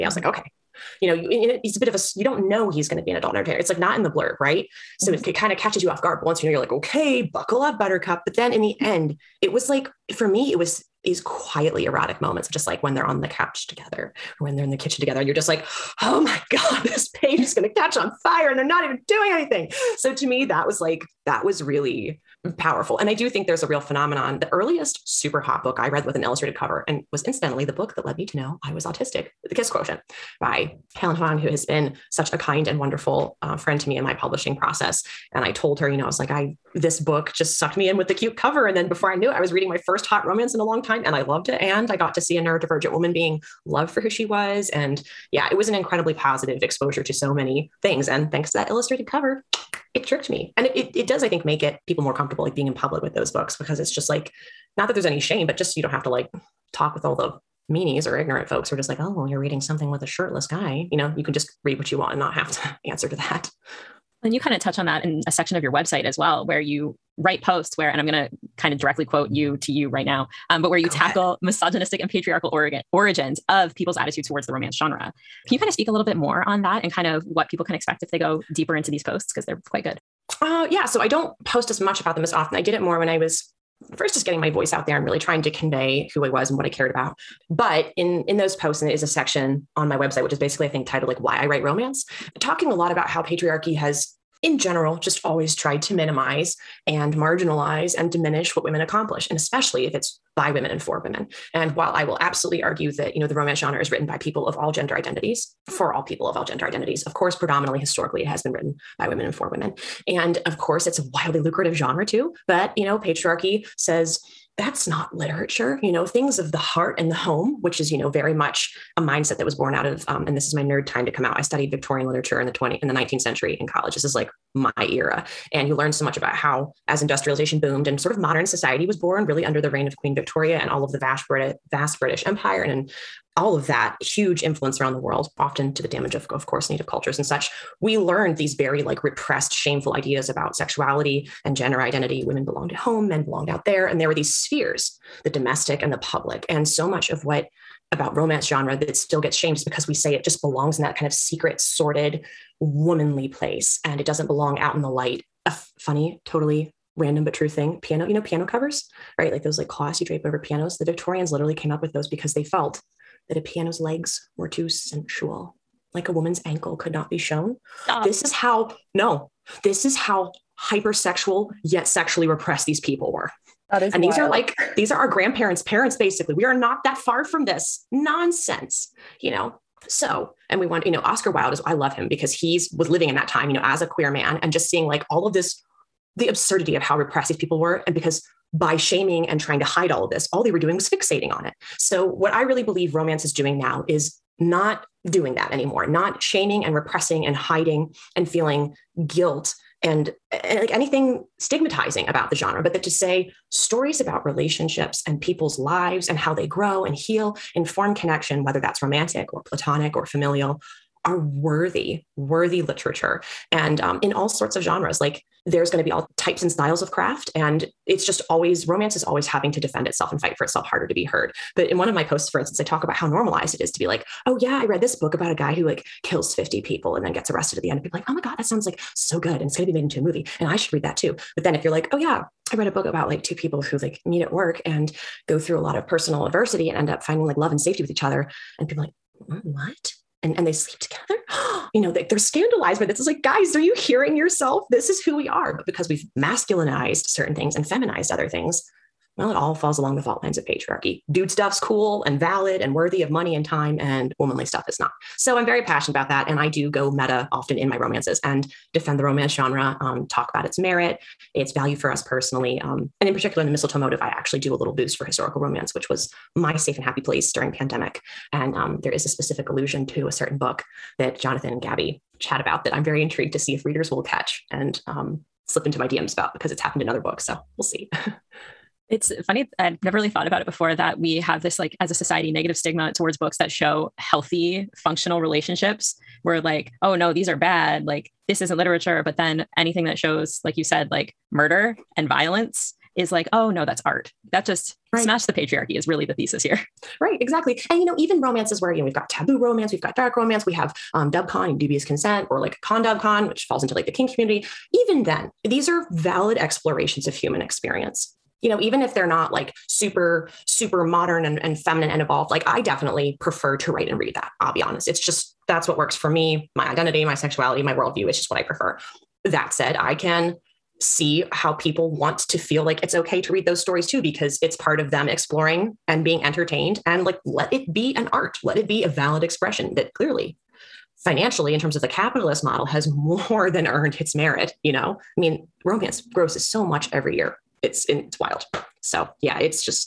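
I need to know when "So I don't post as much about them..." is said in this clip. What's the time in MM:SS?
01:20.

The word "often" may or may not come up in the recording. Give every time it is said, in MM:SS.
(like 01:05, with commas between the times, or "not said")
01:22, 02:15, 04:17.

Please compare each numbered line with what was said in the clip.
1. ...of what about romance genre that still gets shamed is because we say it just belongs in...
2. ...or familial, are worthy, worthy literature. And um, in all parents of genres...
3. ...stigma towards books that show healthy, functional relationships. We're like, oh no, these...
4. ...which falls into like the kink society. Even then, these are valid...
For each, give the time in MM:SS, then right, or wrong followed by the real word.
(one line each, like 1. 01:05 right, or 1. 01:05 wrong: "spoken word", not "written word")
1. 02:27 right
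2. 03:29 wrong: "sorts", not "parents"
3. 04:42 right
4. 05:03 wrong: "community", not "society".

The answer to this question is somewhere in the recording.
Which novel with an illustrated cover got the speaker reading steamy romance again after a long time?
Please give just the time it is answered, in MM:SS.
00:29.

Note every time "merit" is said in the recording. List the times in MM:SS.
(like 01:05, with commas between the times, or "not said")
04:20, 05:34.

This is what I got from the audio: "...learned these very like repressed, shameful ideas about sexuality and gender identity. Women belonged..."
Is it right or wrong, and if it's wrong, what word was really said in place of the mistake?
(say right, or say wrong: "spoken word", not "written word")
right.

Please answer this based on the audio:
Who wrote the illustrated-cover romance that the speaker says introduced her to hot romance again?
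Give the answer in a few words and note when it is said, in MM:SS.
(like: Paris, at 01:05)
Helen Hoang, at 00:30.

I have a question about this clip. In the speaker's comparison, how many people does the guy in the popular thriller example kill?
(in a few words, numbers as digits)
50.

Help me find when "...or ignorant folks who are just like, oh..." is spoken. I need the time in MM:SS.
00:58.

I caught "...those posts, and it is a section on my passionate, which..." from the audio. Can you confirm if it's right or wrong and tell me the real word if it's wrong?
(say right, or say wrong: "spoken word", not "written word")
wrong: "website", not "passionate".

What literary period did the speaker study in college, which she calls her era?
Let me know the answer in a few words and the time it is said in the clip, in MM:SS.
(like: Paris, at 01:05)
Victorian literature, at 02:01.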